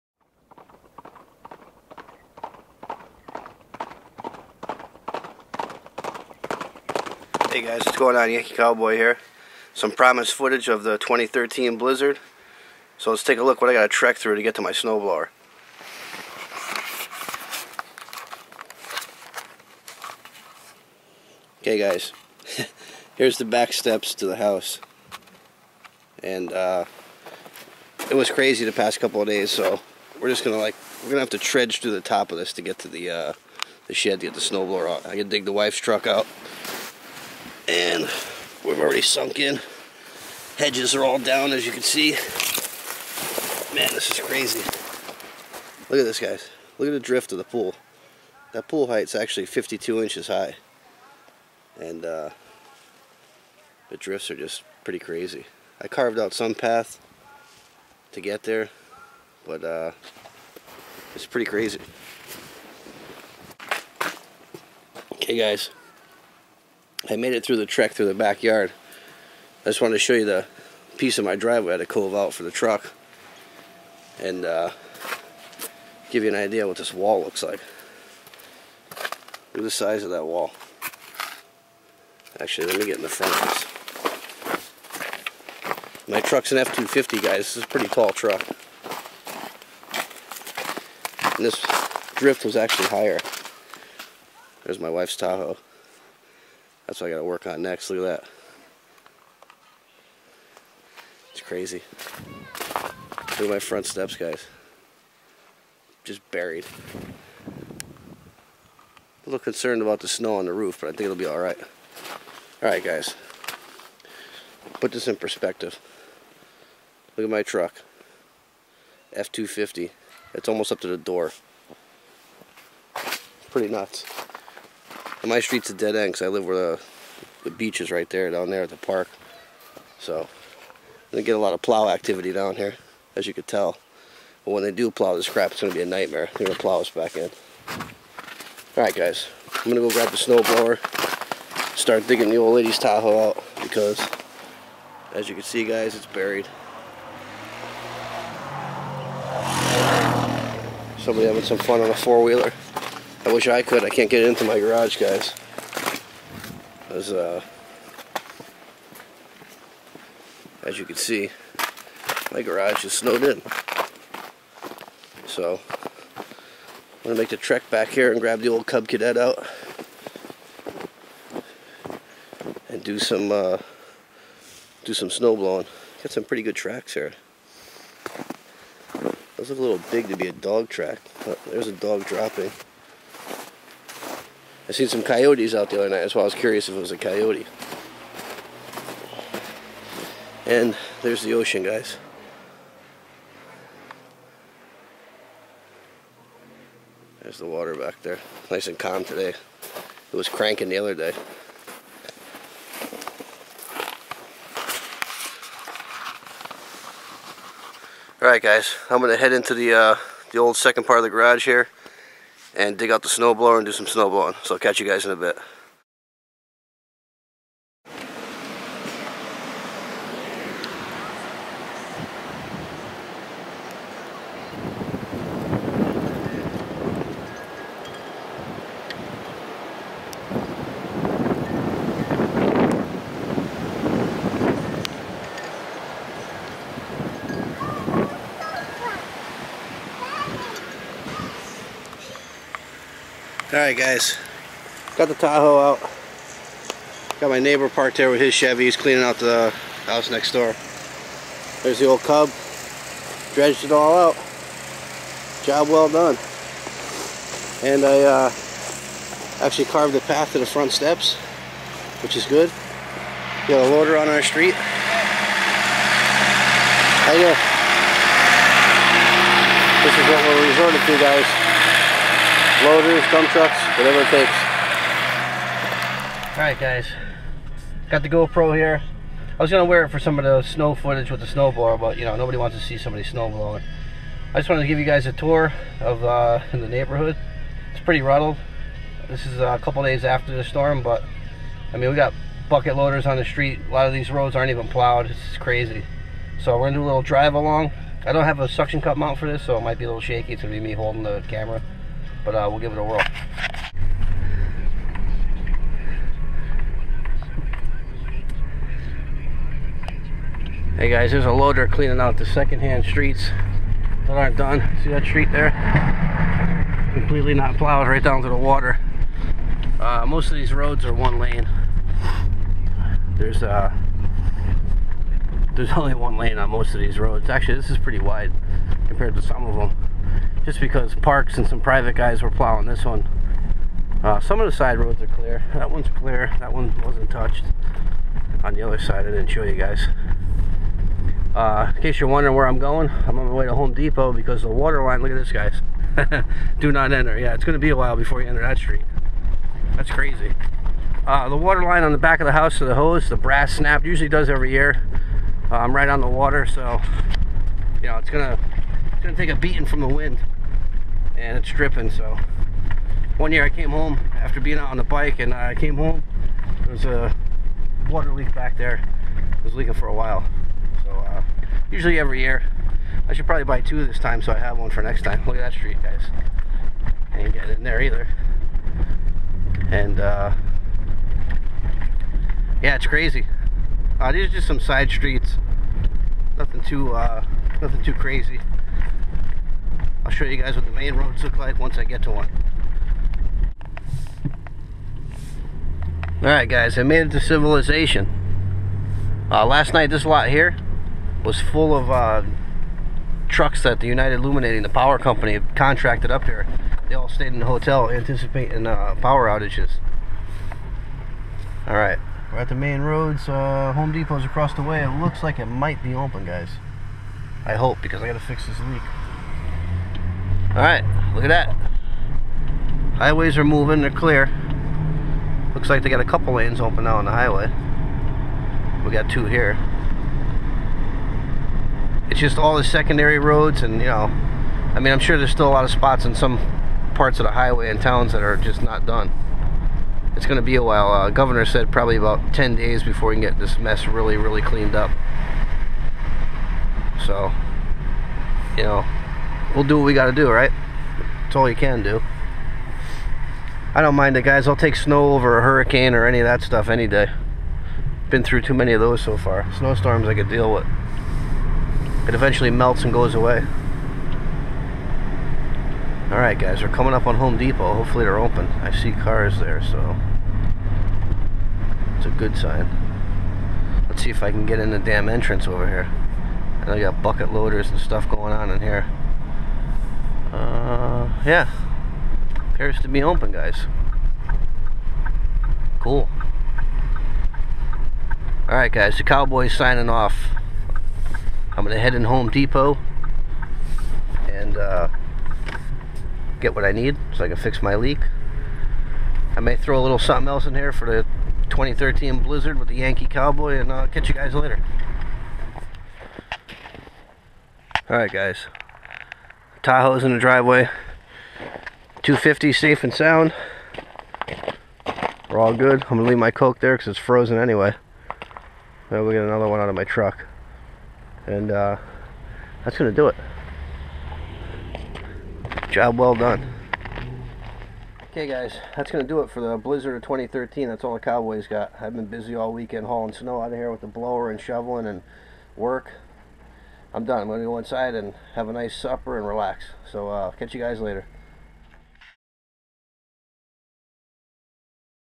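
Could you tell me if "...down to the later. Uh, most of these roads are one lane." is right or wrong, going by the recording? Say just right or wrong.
wrong.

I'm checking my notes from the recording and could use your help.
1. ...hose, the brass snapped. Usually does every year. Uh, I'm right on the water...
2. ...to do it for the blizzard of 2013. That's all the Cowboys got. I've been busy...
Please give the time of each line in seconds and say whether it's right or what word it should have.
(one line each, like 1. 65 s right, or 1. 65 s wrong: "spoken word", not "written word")
1. 352 s right
2. 529 s right.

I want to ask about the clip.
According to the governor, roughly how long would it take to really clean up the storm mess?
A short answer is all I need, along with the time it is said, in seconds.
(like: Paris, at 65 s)
10 days, at 442 s.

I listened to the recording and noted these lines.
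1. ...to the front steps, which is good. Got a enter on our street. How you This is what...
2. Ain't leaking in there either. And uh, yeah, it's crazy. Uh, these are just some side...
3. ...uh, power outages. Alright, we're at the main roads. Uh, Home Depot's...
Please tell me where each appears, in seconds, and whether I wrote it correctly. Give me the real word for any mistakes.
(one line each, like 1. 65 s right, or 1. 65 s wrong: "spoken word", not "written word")
1. 260 s wrong: "loader", not "enter"
2. 377 s wrong: "getting", not "leaking"
3. 408 s right.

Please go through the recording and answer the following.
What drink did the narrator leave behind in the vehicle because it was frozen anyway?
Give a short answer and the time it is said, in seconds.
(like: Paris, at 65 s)
Coke, at 516 s.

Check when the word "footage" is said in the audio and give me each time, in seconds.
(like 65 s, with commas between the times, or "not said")
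10 s, 280 s.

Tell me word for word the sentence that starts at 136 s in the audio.
They're going to plow us back in.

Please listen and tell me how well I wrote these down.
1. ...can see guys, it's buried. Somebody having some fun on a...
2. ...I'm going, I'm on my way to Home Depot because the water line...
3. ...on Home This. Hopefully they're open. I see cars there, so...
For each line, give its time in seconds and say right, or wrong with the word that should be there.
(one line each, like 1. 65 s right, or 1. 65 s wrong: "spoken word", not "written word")
1. 145 s right
2. 342 s right
3. 467 s wrong: "Depot", not "This".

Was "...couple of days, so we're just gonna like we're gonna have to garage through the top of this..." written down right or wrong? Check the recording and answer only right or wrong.
wrong.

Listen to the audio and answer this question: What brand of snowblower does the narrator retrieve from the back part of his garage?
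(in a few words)
Cub Cadet.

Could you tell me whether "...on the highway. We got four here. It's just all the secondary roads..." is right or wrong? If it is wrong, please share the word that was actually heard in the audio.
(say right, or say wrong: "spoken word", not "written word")
wrong: "two", not "four".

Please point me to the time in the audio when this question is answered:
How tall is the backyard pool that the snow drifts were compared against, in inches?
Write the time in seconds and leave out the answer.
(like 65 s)
49 s.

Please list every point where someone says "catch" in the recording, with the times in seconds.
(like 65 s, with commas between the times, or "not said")
214 s, 503 s, 540 s.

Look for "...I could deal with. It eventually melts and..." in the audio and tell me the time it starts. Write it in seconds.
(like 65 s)
460 s.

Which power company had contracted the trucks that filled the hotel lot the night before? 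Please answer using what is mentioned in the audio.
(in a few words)
United Illuminating.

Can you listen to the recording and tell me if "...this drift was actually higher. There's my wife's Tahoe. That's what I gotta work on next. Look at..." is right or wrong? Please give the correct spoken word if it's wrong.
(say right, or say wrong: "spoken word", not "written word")
right.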